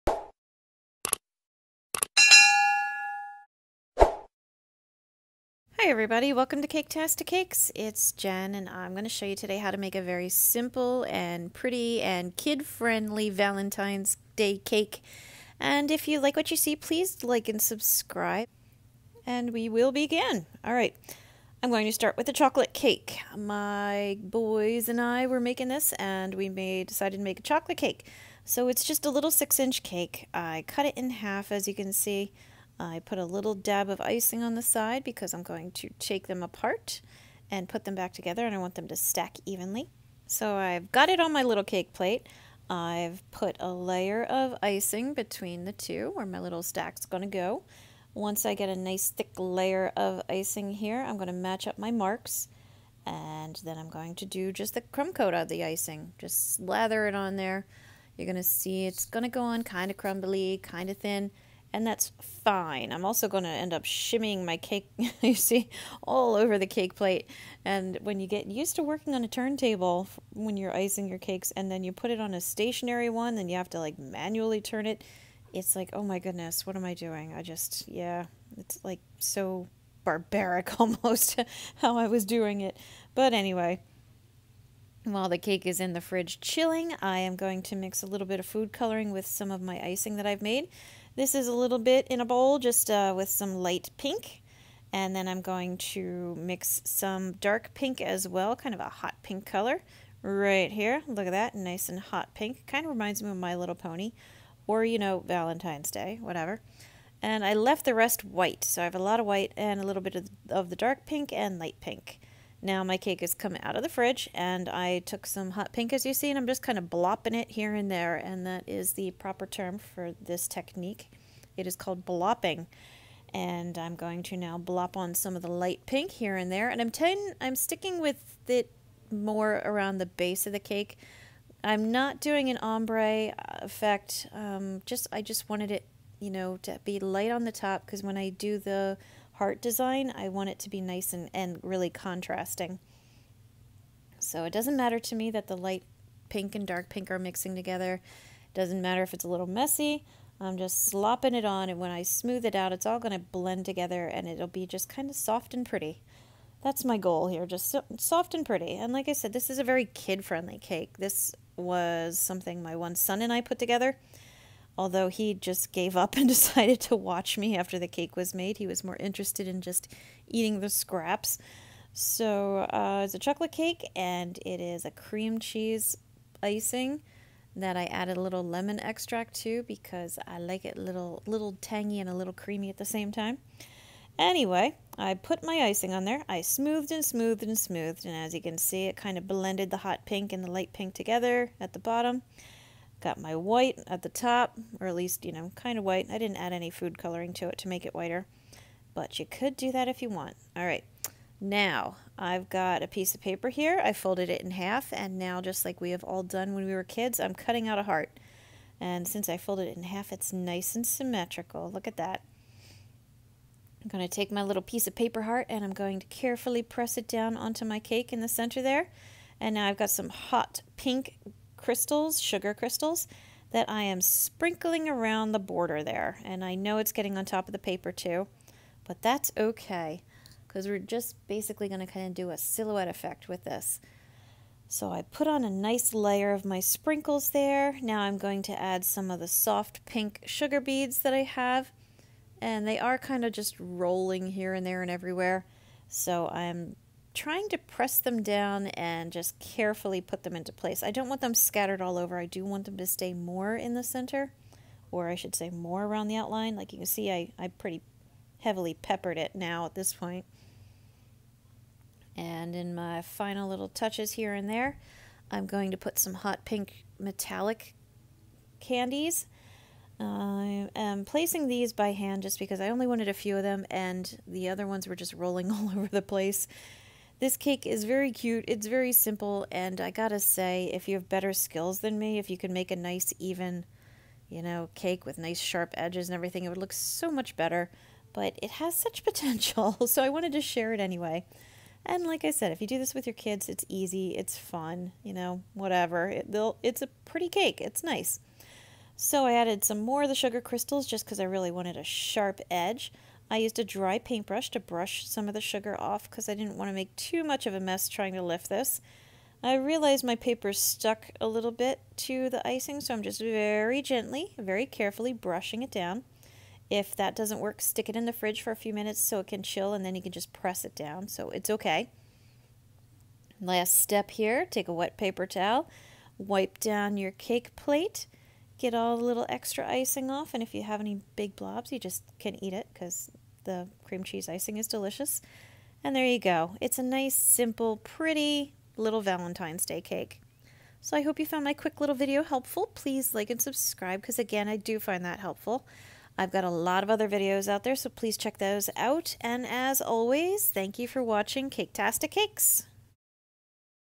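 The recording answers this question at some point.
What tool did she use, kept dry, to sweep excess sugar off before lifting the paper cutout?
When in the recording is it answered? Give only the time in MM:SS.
05:03.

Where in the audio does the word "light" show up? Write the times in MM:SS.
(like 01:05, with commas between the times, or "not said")
01:33, 01:51, 02:05, 02:16, 02:25, 03:10.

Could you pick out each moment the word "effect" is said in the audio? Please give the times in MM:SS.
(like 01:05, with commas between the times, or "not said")
02:13, 03:52.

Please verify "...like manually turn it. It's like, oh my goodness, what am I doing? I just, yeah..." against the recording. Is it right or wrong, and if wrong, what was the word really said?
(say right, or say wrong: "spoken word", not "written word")
right.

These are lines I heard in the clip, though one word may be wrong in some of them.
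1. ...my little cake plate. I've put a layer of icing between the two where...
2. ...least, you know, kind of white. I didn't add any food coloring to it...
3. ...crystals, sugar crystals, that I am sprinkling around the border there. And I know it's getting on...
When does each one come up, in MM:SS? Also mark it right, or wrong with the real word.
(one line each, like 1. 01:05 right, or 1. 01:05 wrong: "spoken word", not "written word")
1. 00:41 right
2. 03:14 right
3. 03:41 right.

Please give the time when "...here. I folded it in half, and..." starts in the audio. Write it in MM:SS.
03:23.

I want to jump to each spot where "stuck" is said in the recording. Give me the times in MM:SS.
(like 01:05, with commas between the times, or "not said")
05:10.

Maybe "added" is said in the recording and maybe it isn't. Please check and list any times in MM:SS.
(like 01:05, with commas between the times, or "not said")
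02:57, 04:59.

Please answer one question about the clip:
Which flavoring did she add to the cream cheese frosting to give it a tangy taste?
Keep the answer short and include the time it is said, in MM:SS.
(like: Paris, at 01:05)
Lemon extract, at 02:58.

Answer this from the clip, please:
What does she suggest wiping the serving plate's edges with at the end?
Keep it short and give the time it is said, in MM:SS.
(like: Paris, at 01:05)
Wet paper towel, at 05:24.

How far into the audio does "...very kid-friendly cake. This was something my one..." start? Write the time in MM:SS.
02:39.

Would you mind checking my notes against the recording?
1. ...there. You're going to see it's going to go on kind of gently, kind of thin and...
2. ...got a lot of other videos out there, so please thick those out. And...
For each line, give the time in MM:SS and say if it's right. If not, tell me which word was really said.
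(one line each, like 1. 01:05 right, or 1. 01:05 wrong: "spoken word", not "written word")
1. 00:57 wrong: "crumbly", not "gently"
2. 05:46 wrong: "check", not "thick".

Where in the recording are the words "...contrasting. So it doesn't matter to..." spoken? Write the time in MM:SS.
02:21.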